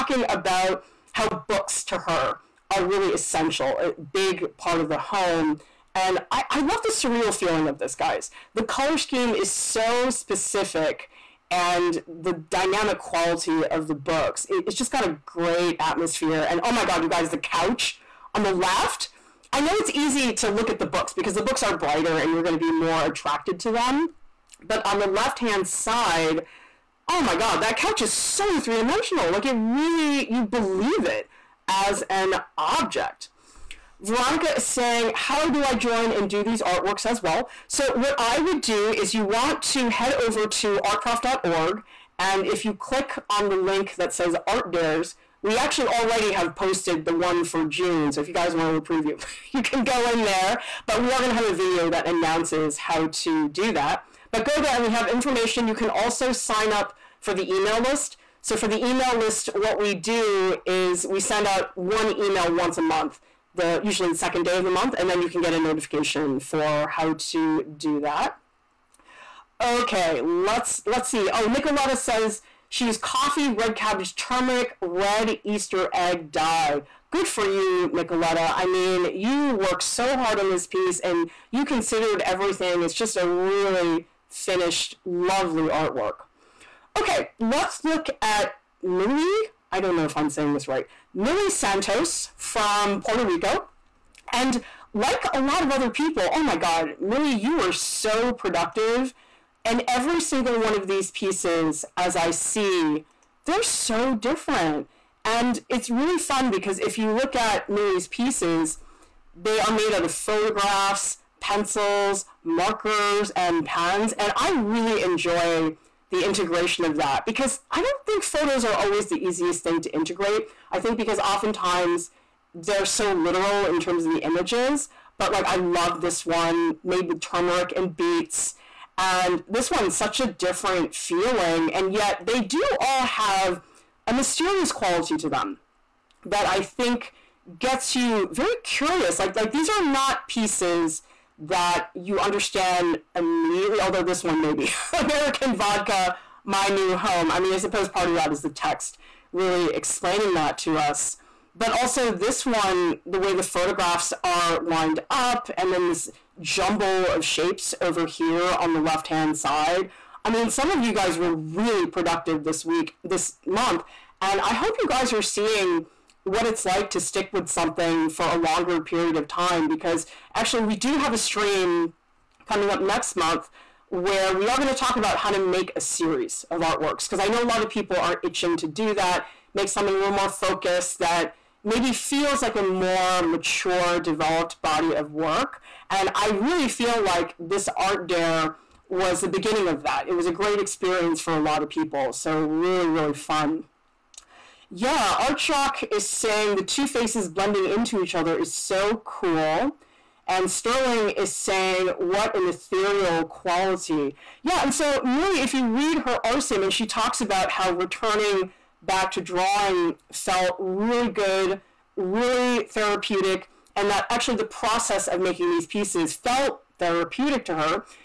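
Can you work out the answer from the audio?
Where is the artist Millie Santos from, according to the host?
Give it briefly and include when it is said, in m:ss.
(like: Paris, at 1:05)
Puerto Rico, at 1:33.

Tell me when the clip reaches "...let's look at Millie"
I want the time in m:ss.
1:27.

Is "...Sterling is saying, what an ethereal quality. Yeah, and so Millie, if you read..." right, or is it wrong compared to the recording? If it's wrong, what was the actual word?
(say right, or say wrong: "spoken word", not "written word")
right.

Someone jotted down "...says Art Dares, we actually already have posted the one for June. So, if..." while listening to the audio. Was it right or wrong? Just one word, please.
right.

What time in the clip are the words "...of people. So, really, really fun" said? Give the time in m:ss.
3:11.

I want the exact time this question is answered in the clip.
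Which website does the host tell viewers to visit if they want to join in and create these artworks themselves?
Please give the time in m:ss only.
0:40.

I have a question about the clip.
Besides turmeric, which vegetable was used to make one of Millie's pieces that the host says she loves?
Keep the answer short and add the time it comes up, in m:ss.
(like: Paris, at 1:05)
beets, at 2:07.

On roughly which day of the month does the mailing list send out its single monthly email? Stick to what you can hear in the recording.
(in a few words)
the second day.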